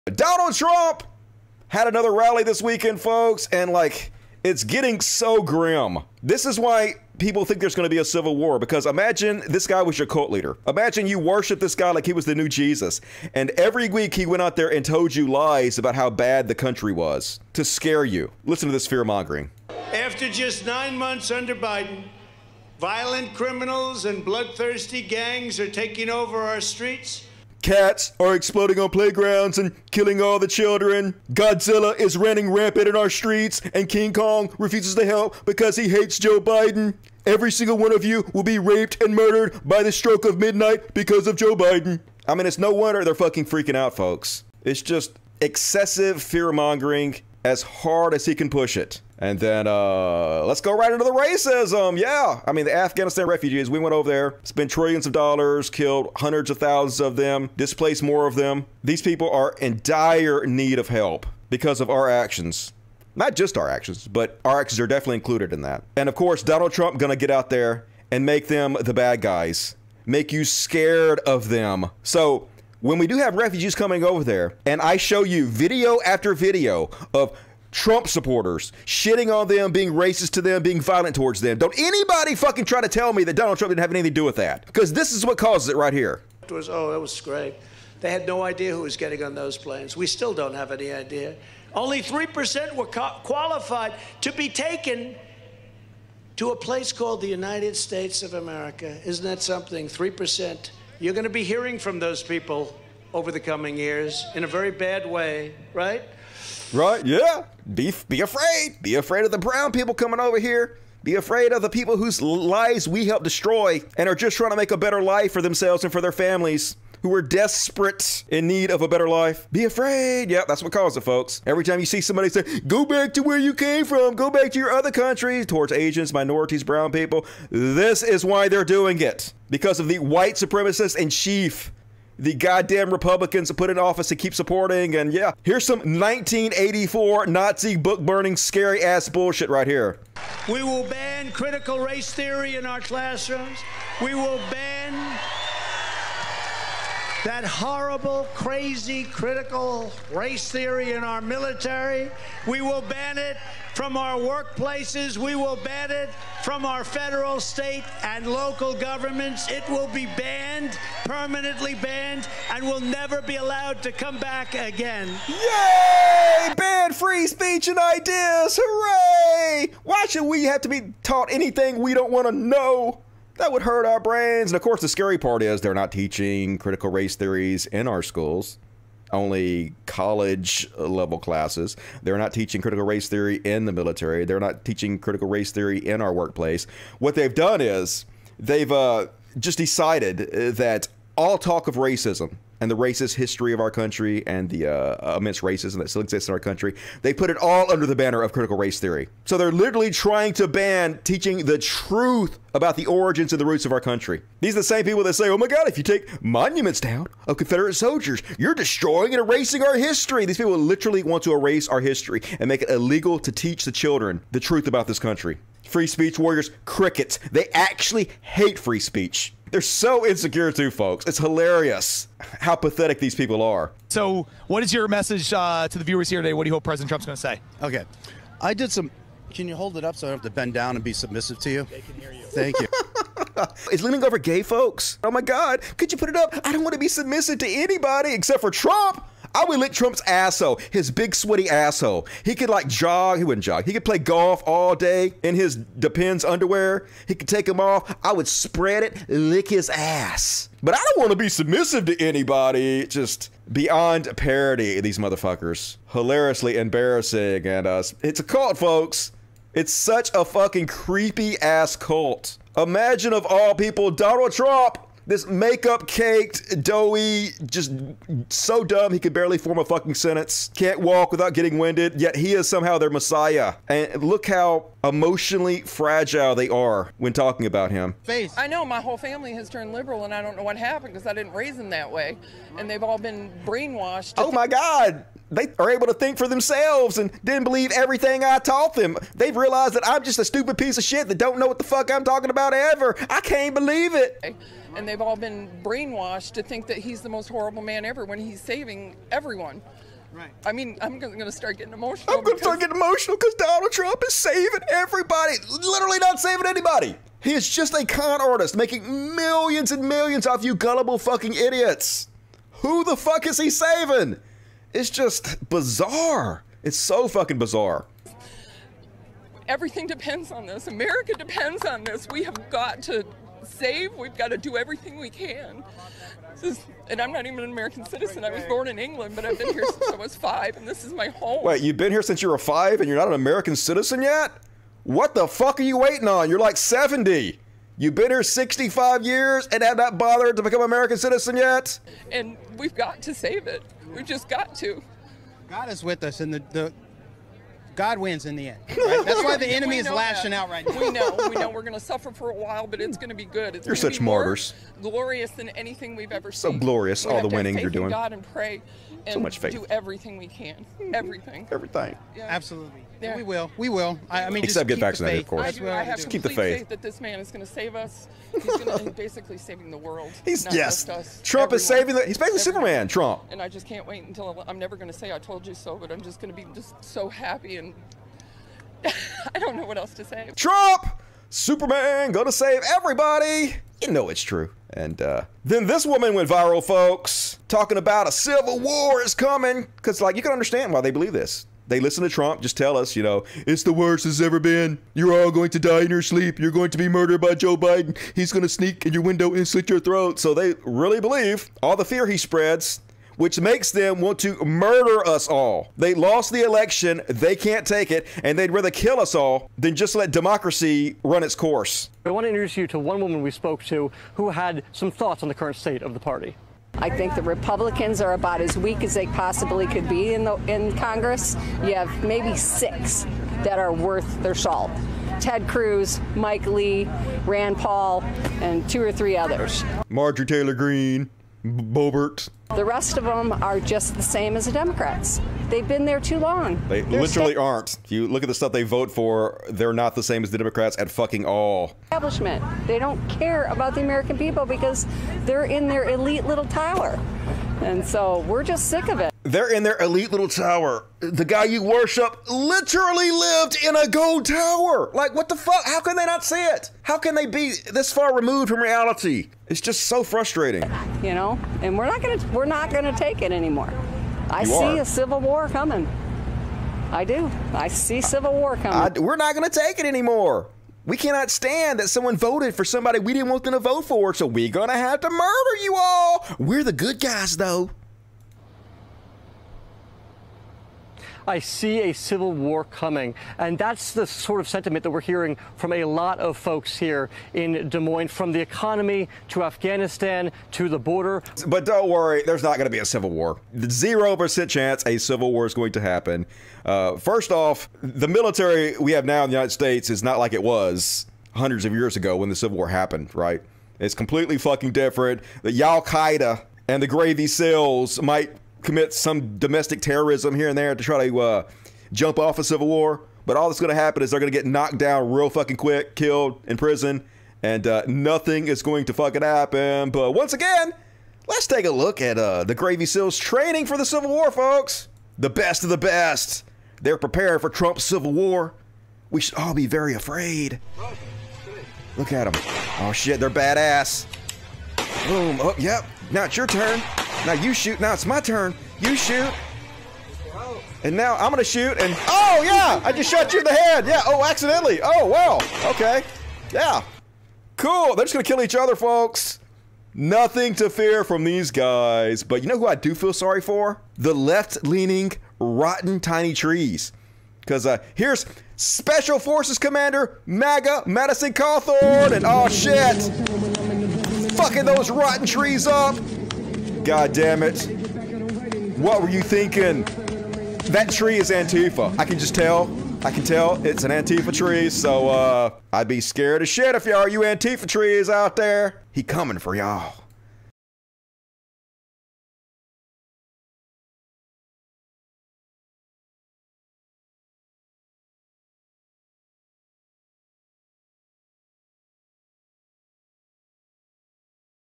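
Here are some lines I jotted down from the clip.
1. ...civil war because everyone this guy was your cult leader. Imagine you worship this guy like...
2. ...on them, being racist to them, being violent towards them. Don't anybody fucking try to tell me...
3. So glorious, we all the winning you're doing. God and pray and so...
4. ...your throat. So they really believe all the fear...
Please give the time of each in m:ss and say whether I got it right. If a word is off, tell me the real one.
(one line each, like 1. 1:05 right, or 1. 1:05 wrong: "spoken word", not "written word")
1. 0:08 wrong: "imagine", not "everyone"
2. 1:19 right
3. 5:56 right
4. 6:39 right.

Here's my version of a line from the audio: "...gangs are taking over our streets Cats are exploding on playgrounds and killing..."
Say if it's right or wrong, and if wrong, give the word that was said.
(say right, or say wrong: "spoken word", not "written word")
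right.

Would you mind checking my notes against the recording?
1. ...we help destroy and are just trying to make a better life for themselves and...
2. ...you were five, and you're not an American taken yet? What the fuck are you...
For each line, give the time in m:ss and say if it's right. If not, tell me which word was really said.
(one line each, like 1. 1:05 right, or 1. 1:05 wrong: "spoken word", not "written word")
1. 1:52 right
2. 5:32 wrong: "citizen", not "taken".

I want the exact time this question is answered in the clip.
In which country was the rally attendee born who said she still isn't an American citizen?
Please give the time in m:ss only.
5:28.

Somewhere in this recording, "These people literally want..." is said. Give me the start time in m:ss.
3:30.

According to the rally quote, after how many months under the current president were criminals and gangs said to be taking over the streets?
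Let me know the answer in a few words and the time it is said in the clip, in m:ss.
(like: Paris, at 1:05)
9, at 0:20.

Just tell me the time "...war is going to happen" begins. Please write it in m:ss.
8:15.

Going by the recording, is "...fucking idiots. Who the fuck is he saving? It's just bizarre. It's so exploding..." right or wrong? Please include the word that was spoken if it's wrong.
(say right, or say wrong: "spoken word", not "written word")
wrong: "fucking", not "exploding".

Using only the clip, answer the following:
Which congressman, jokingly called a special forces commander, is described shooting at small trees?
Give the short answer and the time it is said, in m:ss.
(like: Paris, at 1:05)
Madison Cawthorn, at 9:20.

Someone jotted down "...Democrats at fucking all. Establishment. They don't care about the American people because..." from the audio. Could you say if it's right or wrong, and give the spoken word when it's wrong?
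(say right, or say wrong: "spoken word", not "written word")
right.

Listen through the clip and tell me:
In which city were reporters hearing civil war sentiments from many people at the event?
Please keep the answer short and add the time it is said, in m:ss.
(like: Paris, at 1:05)
Des Moines, at 8:07.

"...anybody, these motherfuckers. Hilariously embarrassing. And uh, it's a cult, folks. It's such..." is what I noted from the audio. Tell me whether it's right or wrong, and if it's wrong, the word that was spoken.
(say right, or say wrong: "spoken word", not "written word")
wrong: "parody", not "anybody".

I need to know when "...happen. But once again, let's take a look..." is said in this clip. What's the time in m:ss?
8:39.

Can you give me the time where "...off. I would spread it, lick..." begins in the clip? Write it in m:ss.
4:07.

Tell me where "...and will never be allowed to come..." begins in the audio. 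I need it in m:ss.
2:42.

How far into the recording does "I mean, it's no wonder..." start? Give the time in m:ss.
0:42.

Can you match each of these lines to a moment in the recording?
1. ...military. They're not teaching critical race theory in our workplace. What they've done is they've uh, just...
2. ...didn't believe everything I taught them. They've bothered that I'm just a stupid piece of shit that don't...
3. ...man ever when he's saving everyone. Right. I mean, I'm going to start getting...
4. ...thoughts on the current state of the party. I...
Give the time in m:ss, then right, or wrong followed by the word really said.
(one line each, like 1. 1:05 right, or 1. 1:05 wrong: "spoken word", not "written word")
1. 3:03 right
2. 4:47 wrong: "realized", not "bothered"
3. 4:57 right
4. 6:54 right.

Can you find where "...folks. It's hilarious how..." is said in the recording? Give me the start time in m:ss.
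3:40.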